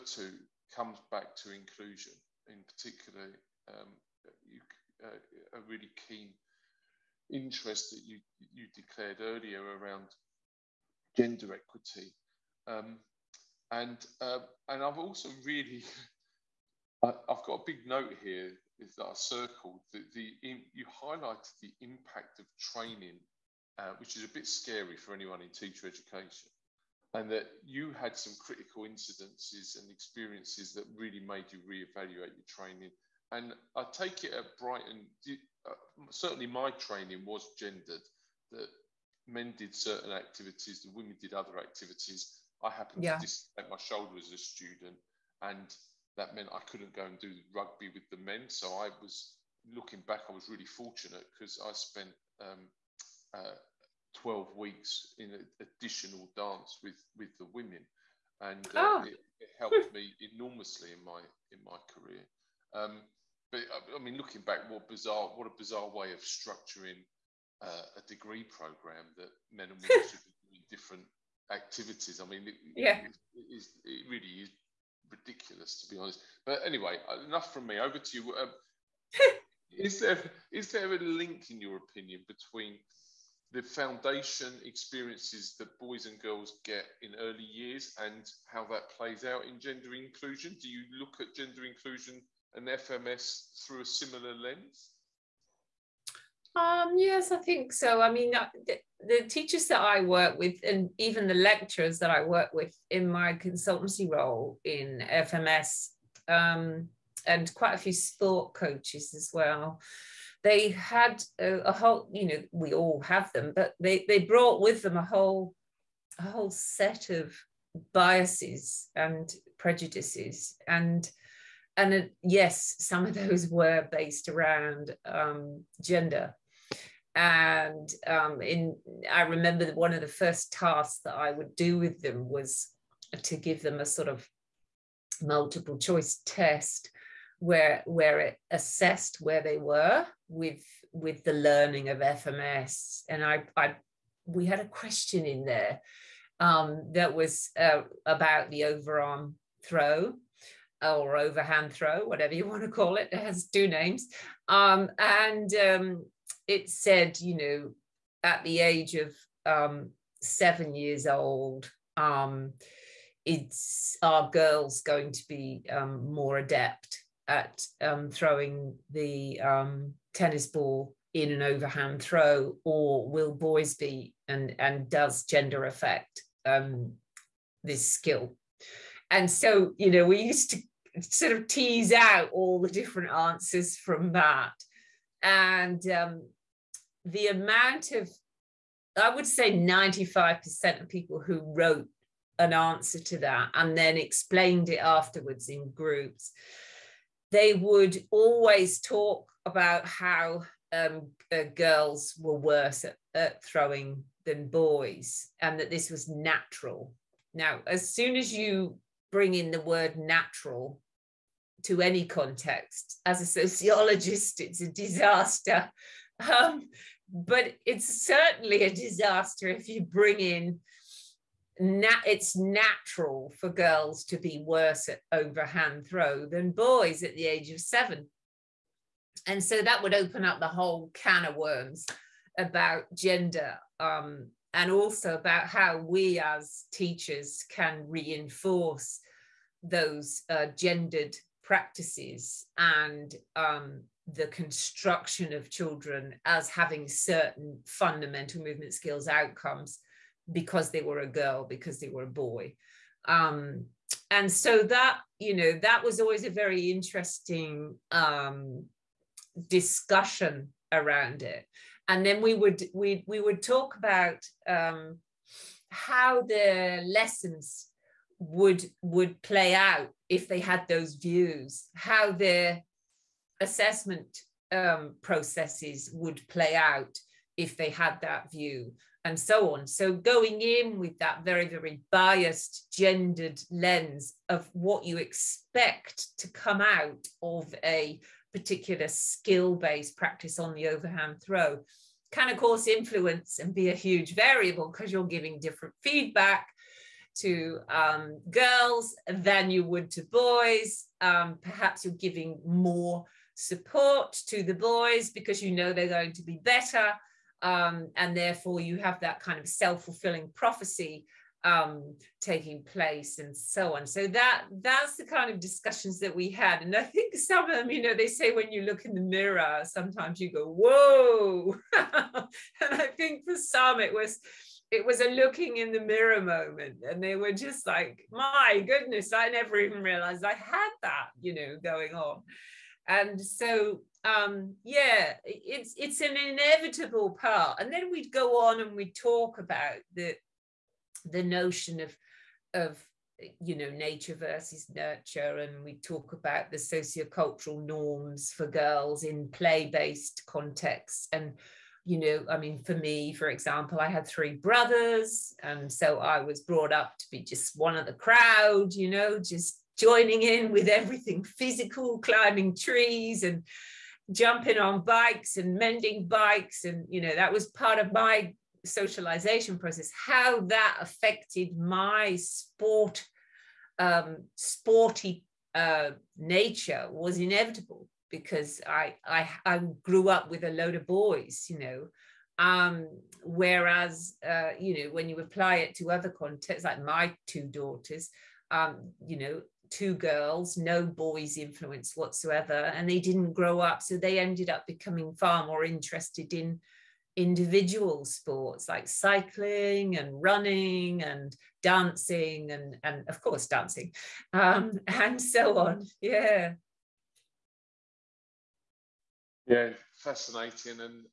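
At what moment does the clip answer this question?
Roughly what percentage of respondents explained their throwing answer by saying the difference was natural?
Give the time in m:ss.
3:09.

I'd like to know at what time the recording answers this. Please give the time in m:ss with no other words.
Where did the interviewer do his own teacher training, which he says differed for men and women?
0:34.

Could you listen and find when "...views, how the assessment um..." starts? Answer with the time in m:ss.
4:30.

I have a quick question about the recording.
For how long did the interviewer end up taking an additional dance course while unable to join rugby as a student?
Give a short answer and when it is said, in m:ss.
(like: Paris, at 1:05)
12 weeks, at 0:54.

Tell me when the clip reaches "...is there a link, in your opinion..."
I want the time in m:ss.
1:20.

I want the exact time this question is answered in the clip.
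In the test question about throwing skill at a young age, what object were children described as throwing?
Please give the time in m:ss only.
2:50.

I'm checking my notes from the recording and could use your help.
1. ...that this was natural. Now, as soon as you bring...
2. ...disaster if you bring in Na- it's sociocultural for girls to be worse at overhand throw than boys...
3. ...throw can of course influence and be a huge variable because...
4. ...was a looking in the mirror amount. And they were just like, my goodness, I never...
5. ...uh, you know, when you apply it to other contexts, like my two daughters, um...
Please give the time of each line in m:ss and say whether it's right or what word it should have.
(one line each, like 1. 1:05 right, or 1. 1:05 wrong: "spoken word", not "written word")
1. 3:25 right
2. 3:38 wrong: "natural", not "sociocultural"
3. 4:51 right
4. 5:24 wrong: "moment", not "amount"
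5. 6:24 right.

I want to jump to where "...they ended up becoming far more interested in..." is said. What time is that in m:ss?
6:33.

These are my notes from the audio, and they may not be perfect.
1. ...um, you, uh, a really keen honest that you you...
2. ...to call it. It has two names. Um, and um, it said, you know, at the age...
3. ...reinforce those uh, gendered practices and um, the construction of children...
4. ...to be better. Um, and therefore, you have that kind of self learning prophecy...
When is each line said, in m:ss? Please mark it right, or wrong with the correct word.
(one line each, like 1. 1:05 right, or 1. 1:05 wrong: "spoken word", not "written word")
1. 0:03 wrong: "interest", not "honest"
2. 2:32 right
3. 3:57 right
4. 5:06 wrong: "fulfilling", not "learning".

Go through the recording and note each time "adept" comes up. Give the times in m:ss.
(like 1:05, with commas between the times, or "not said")
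2:46.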